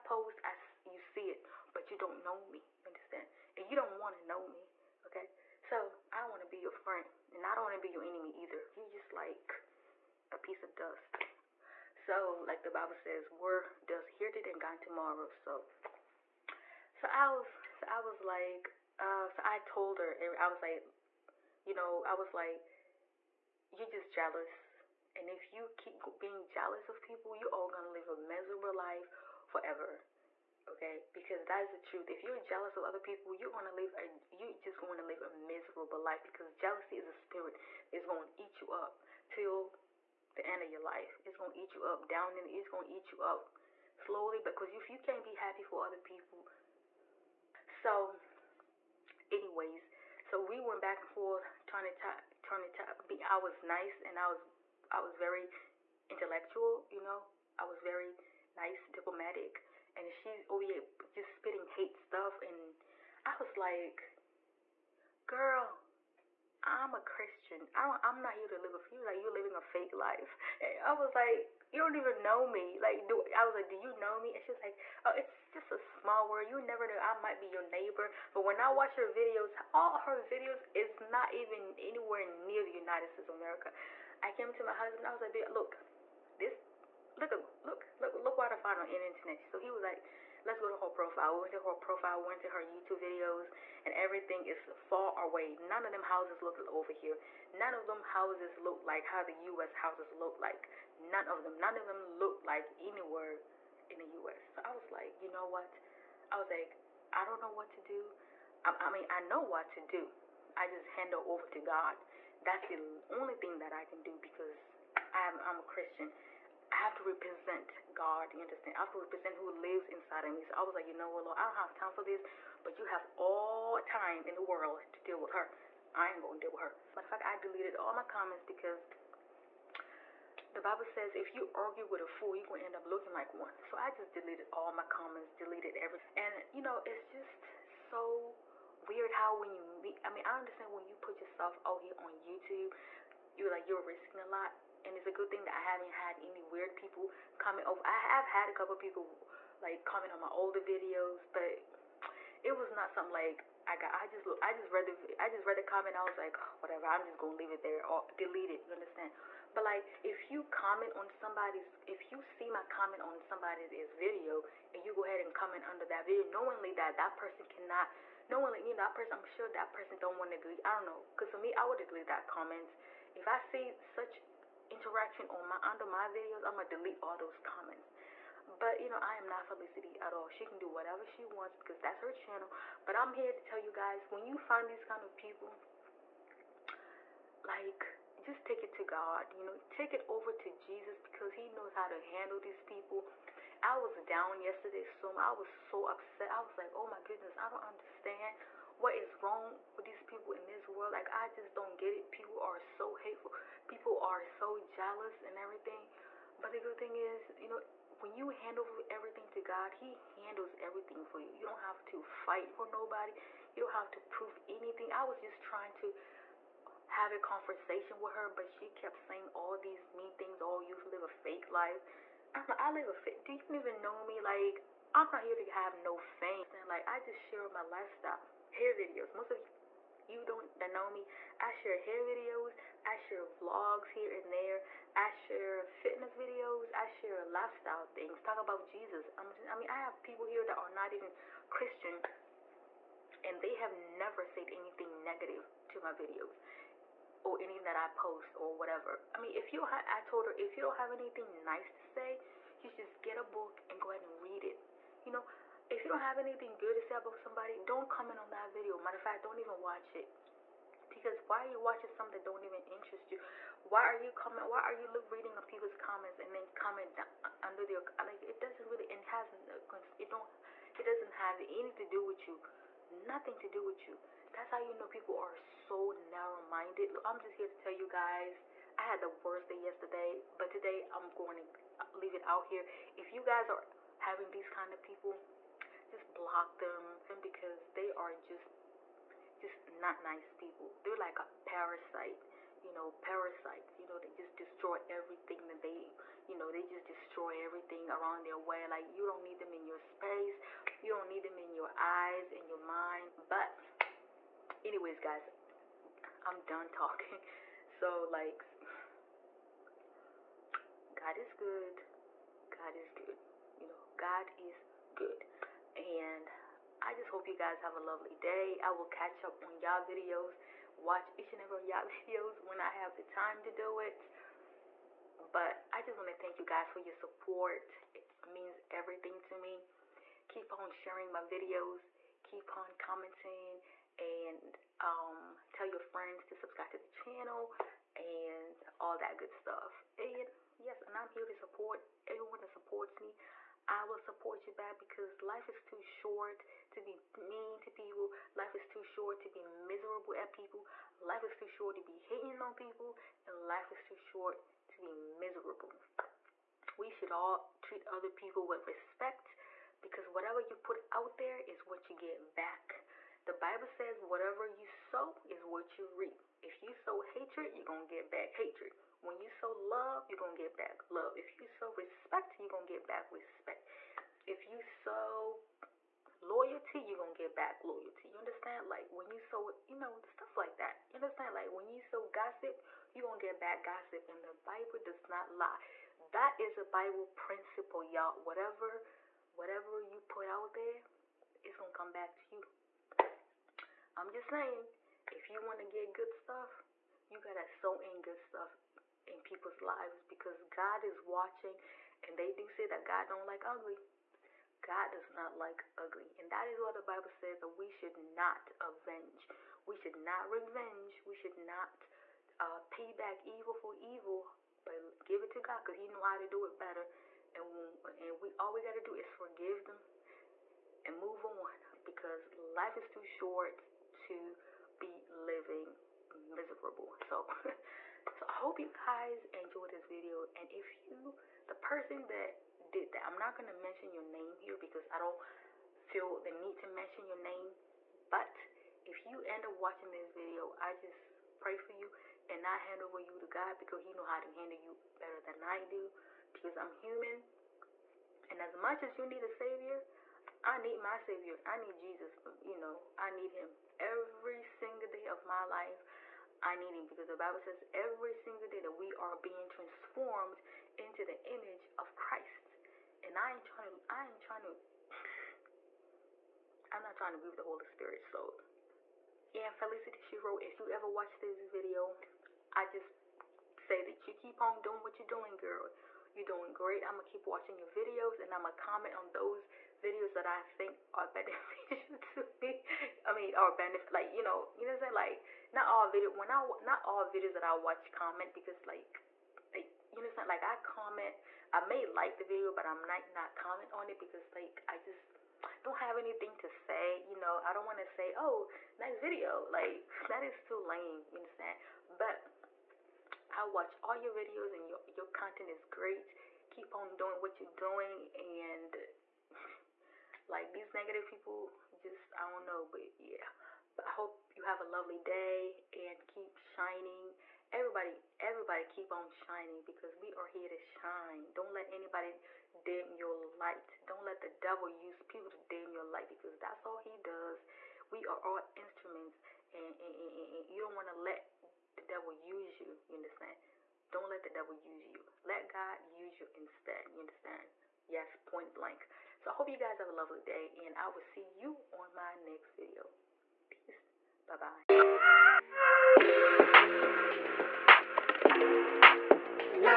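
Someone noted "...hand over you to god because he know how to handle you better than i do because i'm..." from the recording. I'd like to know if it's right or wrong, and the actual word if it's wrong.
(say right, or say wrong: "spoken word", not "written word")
right.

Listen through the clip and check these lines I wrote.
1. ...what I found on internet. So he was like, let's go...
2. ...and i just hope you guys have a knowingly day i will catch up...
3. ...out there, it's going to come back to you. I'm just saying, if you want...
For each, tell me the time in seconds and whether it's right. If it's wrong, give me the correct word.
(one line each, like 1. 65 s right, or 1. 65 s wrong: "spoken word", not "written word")
1. 88 s right
2. 315 s wrong: "lovely", not "knowingly"
3. 390 s right.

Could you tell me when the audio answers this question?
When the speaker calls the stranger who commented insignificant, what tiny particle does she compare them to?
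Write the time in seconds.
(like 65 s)
10 s.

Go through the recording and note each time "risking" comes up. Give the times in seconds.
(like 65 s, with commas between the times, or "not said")
143 s.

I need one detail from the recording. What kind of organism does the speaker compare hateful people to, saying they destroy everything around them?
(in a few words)
Parasites.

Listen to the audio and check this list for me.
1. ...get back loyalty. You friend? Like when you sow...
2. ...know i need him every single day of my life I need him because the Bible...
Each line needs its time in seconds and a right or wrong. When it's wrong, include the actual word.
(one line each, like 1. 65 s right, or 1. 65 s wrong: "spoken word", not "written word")
1. 377 s wrong: "understand", not "friend"
2. 452 s right.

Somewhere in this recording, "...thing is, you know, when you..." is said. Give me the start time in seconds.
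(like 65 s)
206 s.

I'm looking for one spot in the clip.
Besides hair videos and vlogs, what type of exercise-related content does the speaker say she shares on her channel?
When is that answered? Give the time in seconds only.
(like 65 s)
235 s.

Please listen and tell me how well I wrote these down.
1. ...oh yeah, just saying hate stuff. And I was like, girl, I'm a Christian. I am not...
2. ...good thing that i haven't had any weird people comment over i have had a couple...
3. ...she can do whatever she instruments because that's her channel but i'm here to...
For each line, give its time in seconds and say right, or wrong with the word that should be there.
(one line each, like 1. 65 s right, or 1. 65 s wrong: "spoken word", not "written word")
1. 60 s wrong: "spitting", not "saying"
2. 145 s right
3. 180 s wrong: "wants", not "instruments".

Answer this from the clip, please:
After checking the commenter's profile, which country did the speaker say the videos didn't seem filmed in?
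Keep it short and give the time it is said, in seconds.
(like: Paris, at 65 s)
United States of America, at 82 s.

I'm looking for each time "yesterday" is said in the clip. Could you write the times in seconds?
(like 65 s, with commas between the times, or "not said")
194 s, 279 s.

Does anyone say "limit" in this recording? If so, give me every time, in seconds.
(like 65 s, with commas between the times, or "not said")
not said.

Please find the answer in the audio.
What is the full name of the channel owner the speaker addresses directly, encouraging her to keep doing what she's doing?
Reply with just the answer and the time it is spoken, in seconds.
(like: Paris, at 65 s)
Felicity Shiru, at 469 s.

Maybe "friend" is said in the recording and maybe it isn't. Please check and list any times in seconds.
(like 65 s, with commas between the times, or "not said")
6 s, 335 s.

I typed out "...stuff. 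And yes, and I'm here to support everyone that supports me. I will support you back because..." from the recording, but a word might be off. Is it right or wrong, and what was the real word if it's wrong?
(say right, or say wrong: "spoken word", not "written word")
right.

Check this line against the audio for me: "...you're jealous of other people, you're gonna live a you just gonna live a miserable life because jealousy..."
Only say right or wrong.
right.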